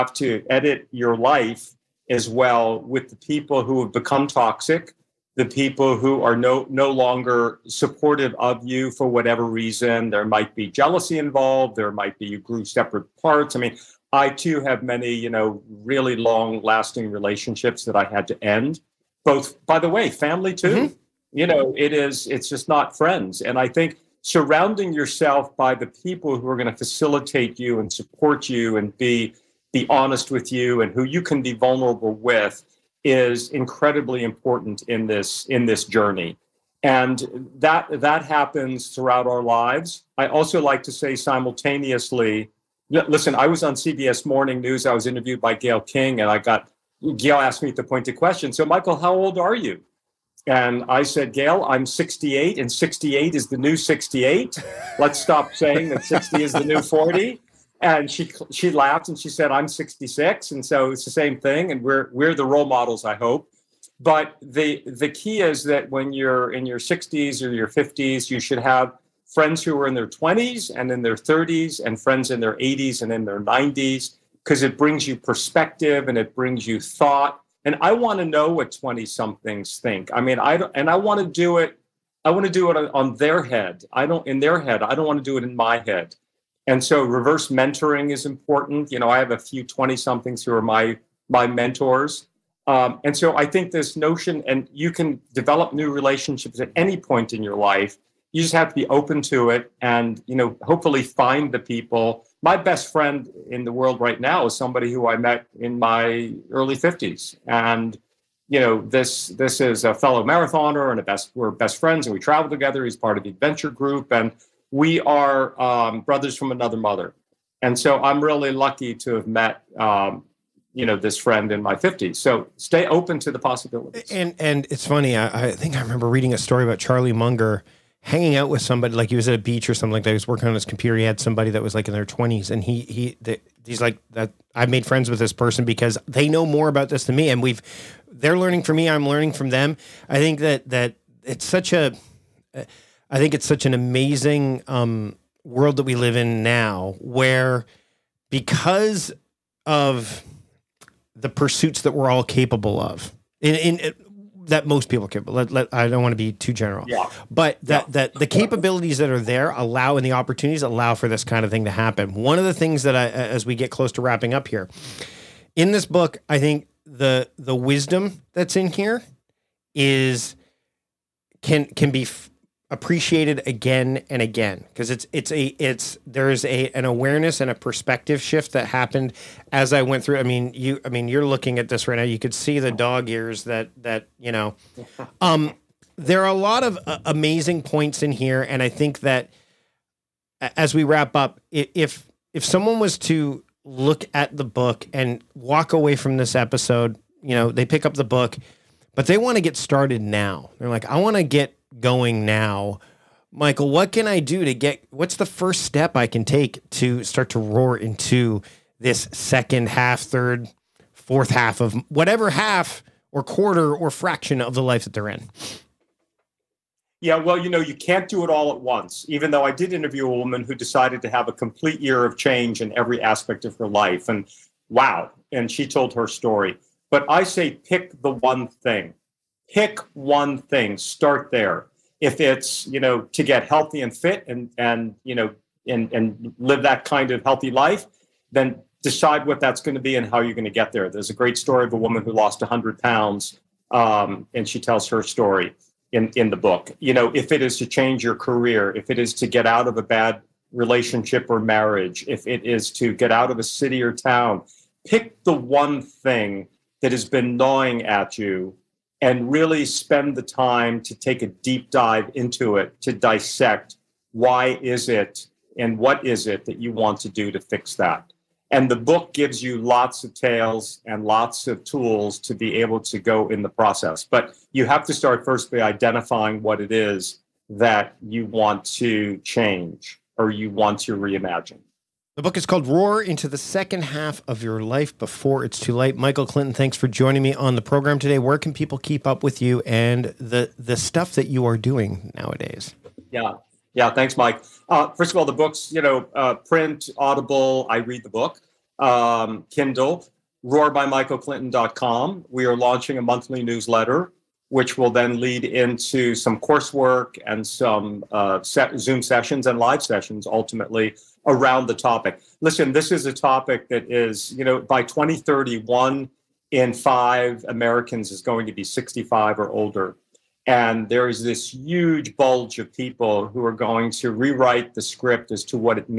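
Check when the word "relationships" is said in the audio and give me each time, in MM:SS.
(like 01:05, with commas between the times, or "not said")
00:17, 01:35, 04:10.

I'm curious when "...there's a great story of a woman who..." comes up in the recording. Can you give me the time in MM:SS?
04:00.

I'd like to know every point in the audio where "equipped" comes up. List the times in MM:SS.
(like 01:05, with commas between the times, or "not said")
not said.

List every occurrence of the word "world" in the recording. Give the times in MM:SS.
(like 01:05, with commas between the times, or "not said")
01:43, 02:25.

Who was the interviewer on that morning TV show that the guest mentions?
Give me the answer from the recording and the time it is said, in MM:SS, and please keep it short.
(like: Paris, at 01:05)
Gayle King, at 00:45.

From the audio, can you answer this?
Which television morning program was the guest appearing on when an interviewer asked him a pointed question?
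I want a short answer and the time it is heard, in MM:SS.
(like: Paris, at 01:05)
CBS Morning News, at 00:43.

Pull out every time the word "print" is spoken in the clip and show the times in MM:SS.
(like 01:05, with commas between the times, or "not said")
04:56.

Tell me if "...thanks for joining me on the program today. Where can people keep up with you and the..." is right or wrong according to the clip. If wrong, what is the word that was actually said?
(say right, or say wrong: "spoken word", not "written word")
right.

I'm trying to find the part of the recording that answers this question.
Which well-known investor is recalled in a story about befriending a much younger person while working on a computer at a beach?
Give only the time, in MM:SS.
02:06.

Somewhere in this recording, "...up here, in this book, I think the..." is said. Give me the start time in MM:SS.
02:44.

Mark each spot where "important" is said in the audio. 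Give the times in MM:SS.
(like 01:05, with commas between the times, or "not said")
00:34, 01:28.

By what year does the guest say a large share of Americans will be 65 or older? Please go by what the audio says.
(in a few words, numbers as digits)
2031.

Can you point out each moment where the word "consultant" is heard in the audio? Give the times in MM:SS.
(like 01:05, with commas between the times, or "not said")
not said.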